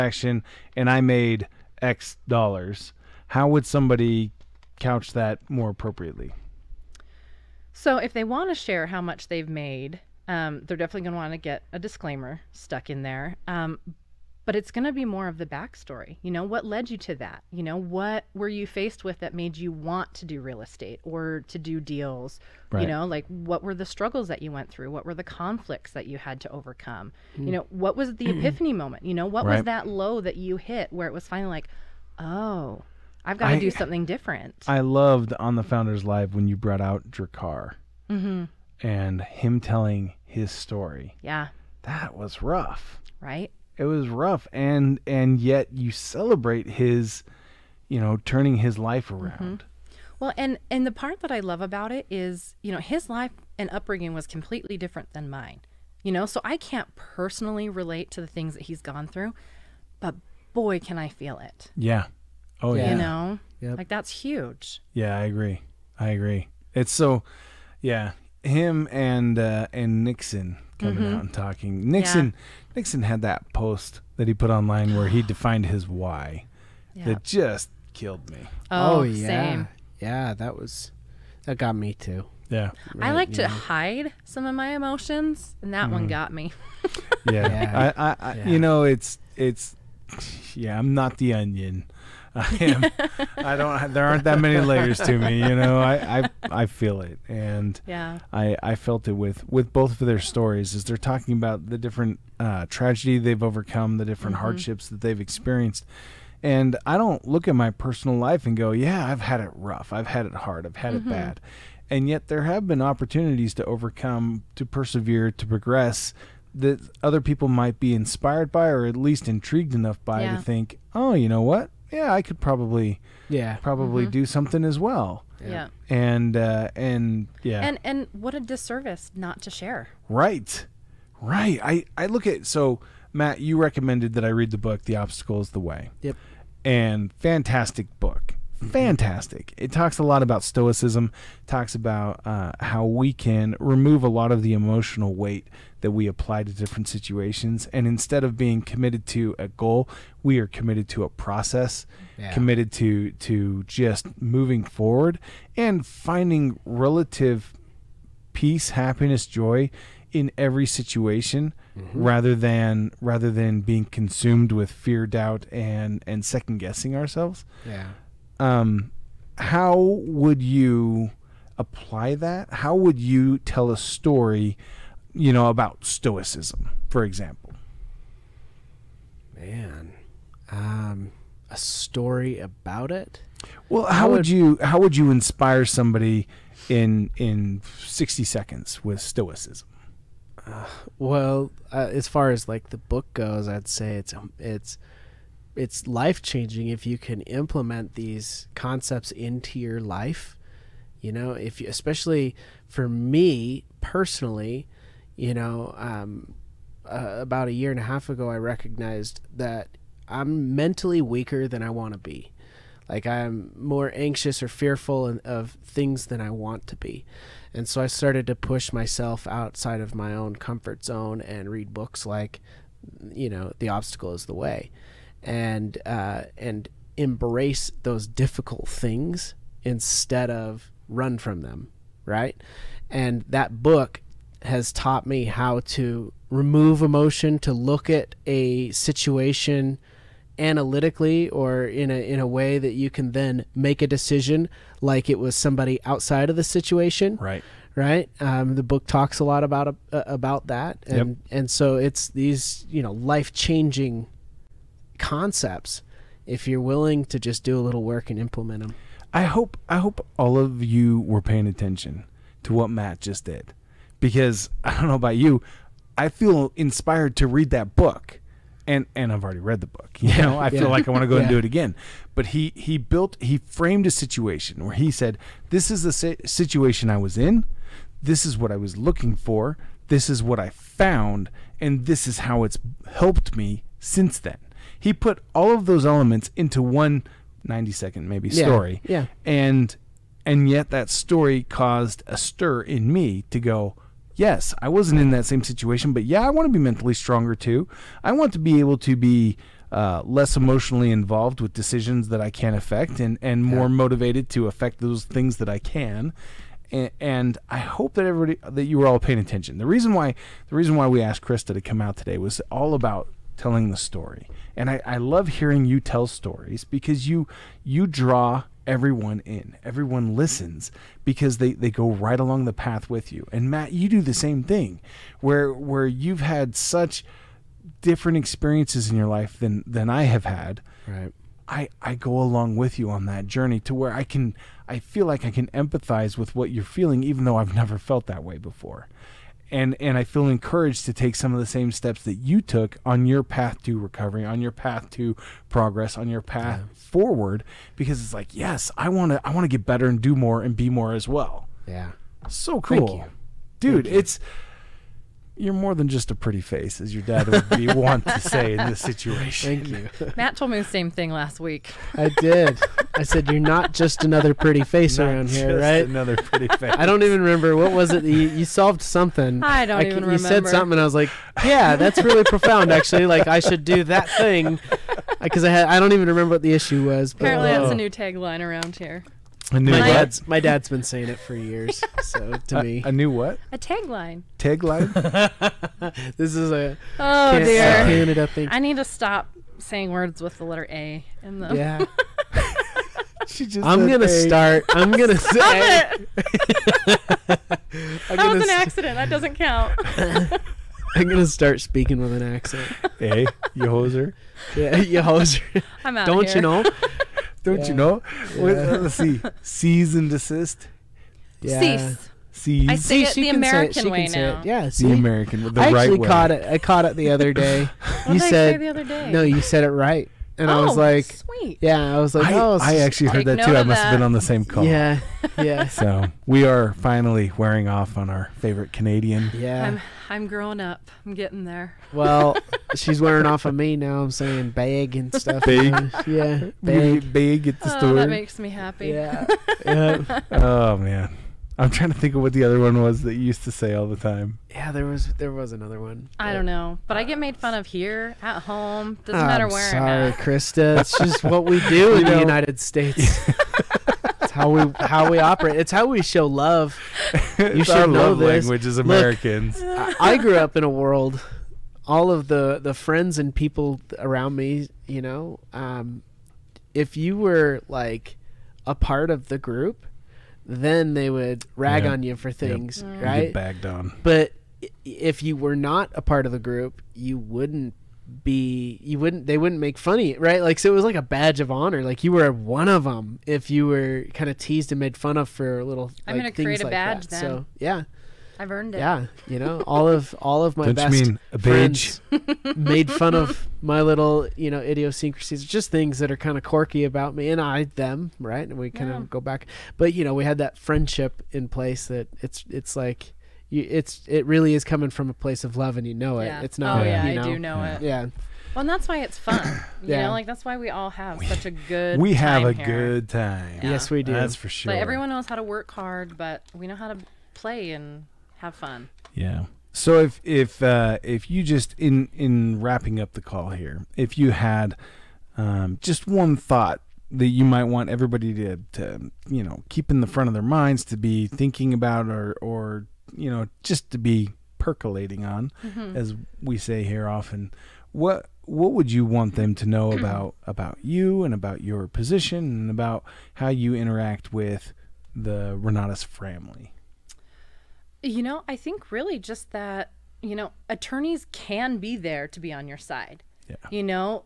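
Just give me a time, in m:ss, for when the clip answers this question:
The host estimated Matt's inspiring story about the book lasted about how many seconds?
4:47.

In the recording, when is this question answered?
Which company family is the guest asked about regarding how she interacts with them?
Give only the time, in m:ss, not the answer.
9:05.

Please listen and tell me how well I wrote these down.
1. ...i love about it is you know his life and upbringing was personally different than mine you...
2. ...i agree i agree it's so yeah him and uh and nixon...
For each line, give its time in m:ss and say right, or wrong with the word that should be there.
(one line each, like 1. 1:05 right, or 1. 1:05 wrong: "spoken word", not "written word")
1. 0:51 wrong: "completely", not "personally"
2. 1:05 right.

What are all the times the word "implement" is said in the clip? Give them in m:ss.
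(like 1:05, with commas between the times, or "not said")
3:17, 4:18.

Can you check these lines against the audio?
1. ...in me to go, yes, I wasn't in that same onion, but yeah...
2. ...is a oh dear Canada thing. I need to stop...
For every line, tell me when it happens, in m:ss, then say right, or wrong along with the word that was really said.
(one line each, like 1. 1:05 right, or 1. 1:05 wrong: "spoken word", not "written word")
1. 4:52 wrong: "situation", not "onion"
2. 6:26 right.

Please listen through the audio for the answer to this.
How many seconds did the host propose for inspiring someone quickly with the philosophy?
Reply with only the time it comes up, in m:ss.
3:07.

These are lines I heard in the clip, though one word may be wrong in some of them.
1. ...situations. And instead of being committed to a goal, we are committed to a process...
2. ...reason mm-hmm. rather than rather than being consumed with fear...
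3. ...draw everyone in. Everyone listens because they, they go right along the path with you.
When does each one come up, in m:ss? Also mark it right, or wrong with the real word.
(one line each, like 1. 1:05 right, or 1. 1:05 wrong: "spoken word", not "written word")
1. 2:26 right
2. 2:40 wrong: "situation", not "reason"
3. 5:17 right.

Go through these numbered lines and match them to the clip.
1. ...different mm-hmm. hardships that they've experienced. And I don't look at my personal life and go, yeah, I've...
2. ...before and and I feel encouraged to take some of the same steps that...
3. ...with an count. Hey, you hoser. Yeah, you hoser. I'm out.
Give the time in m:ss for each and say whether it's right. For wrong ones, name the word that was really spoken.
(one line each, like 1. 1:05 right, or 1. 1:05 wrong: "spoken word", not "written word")
1. 1:44 right
2. 5:38 right
3. 6:42 wrong: "accent", not "count".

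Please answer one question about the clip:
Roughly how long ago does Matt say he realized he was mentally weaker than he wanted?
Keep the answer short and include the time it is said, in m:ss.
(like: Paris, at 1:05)
a year and a half, at 3:27.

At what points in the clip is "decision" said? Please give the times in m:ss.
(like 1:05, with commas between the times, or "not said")
4:03, 5:01.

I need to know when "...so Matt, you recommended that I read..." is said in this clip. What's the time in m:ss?
2:12.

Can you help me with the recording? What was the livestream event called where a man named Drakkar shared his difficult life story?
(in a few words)
Founders Live.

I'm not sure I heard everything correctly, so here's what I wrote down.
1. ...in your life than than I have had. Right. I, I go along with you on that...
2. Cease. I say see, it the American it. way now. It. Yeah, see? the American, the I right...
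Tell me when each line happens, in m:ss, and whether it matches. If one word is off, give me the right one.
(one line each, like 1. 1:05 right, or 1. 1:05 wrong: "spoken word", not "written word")
1. 5:28 right
2. 6:52 right.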